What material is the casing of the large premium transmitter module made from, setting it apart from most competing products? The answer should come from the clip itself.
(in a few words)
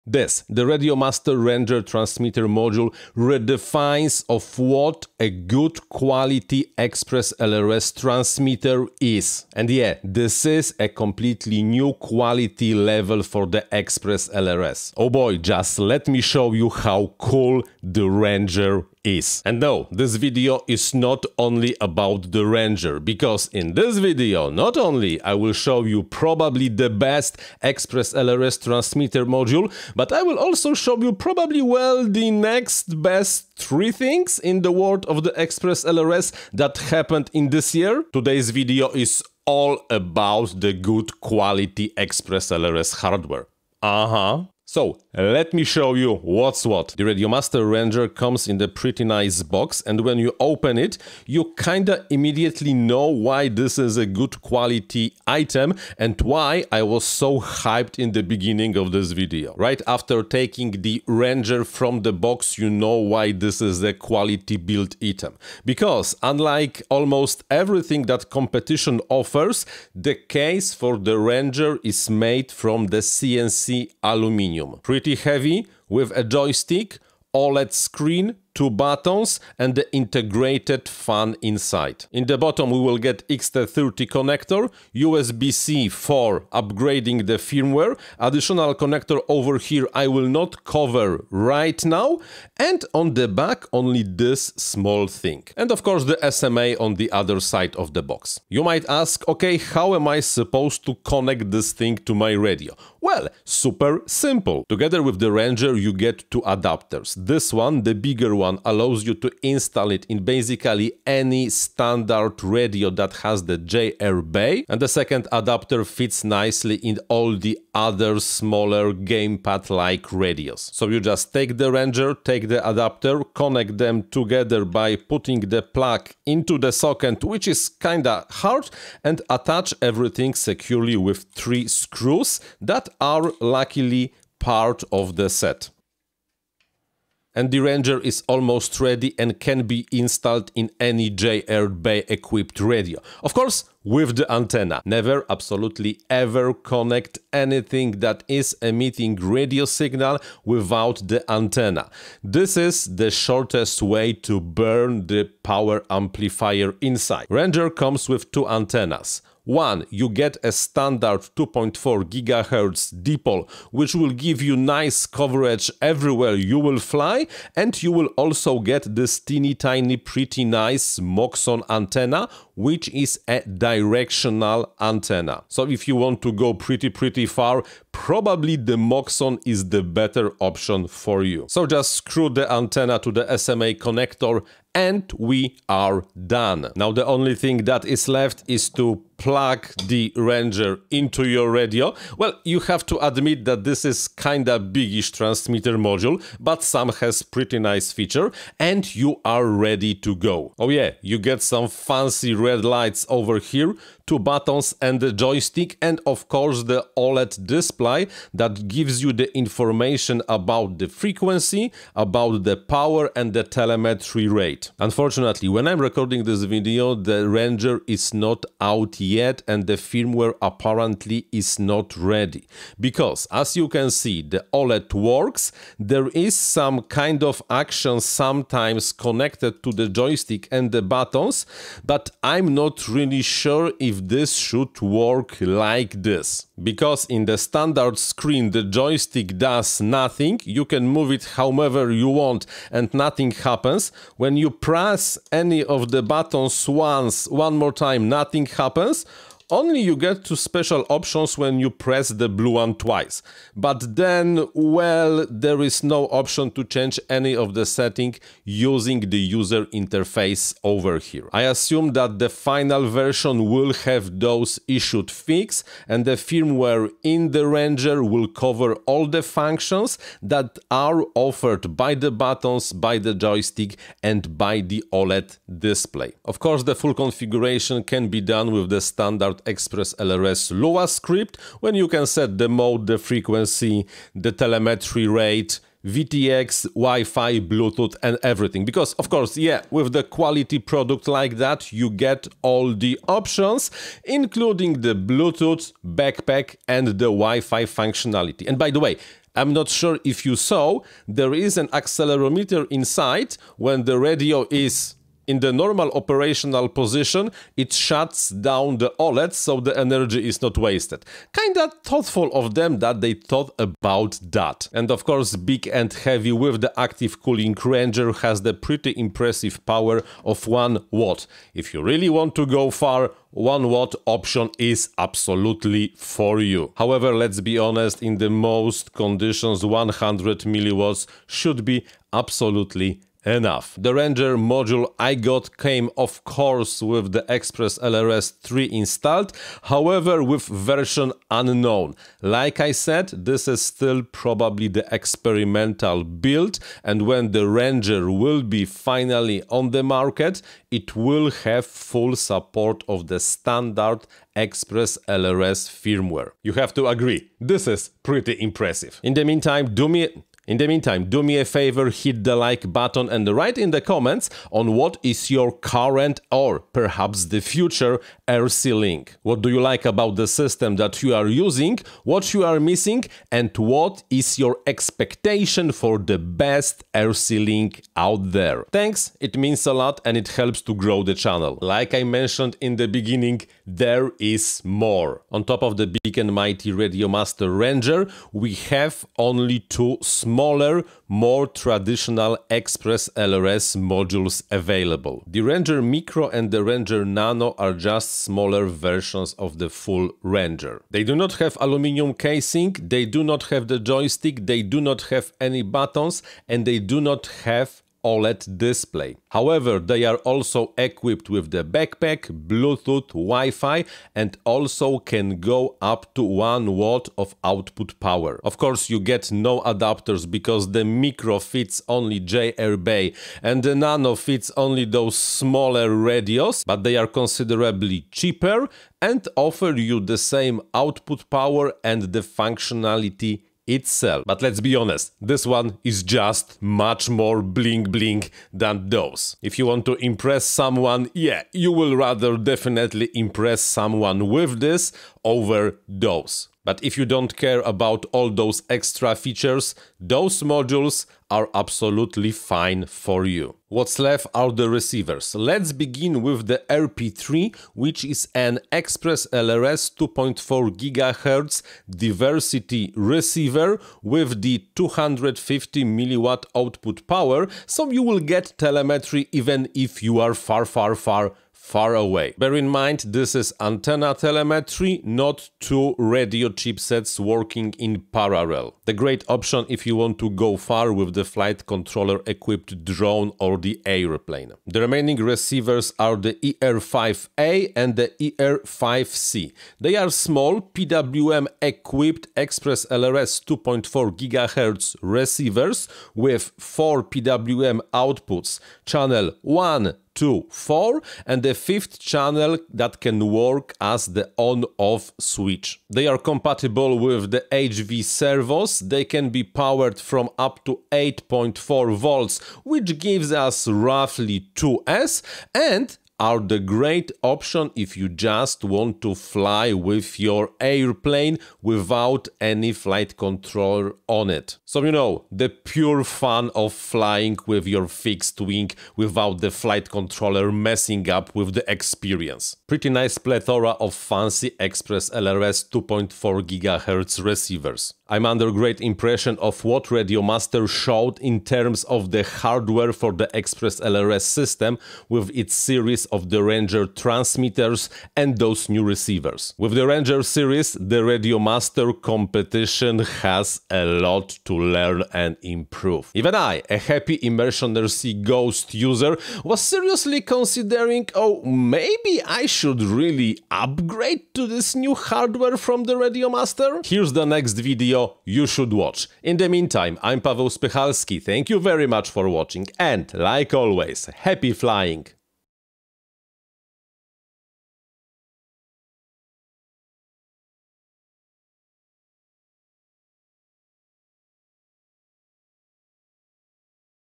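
CNC aluminium.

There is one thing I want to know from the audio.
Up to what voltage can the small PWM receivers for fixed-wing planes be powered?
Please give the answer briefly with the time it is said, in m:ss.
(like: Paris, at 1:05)
8.4 volts, at 8:30.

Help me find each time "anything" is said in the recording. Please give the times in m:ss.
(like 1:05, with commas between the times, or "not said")
2:27.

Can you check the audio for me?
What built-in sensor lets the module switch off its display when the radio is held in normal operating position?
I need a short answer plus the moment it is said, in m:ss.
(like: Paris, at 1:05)
accelerometer, at 5:01.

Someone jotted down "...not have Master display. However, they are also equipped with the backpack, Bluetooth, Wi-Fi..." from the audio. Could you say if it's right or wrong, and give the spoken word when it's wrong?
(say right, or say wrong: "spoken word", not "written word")
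wrong: "OLED", not "Master".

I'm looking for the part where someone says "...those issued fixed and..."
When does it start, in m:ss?
4:24.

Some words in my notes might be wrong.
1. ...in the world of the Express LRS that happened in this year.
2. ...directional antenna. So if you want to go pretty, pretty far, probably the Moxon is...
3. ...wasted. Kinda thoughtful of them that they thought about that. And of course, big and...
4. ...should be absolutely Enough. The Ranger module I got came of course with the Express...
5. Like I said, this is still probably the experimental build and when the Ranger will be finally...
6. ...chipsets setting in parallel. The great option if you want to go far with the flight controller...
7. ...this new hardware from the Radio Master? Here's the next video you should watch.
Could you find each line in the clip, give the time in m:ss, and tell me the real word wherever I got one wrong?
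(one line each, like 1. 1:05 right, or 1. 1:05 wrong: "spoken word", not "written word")
1. 0:34 right
2. 2:53 right
3. 5:10 right
4. 5:31 right
5. 5:42 right
6. 7:56 wrong: "working", not "setting"
7. 9:24 right.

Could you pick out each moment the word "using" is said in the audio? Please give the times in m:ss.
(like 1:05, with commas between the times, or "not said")
4:18, 6:11.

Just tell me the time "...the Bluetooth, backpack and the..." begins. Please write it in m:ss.
4:54.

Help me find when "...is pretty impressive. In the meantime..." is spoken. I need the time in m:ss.
5:57.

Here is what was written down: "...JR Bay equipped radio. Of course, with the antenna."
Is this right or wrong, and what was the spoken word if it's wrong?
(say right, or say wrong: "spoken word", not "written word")
right.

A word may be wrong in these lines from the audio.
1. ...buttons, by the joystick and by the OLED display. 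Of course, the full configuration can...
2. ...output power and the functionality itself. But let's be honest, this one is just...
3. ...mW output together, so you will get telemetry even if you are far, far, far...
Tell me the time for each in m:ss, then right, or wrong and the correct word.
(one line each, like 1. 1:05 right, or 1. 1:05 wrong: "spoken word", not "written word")
1. 4:32 right
2. 7:10 right
3. 7:45 wrong: "power", not "together".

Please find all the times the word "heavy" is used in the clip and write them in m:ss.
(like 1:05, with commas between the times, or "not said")
1:15, 5:15.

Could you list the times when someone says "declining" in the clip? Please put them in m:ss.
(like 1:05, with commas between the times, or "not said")
not said.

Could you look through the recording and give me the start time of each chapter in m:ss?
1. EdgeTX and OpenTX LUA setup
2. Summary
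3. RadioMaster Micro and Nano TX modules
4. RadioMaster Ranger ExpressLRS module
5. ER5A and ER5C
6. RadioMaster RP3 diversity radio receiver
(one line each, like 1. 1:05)
1. 4:35
2. 8:57
3. 6:24
4. 0:46
5. 8:04
6. 7:33.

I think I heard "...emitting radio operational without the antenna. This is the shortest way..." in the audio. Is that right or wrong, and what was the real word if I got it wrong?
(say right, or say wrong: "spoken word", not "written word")
wrong: "signal", not "operational".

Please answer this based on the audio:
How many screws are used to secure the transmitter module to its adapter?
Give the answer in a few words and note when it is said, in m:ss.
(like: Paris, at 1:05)
3, at 2:11.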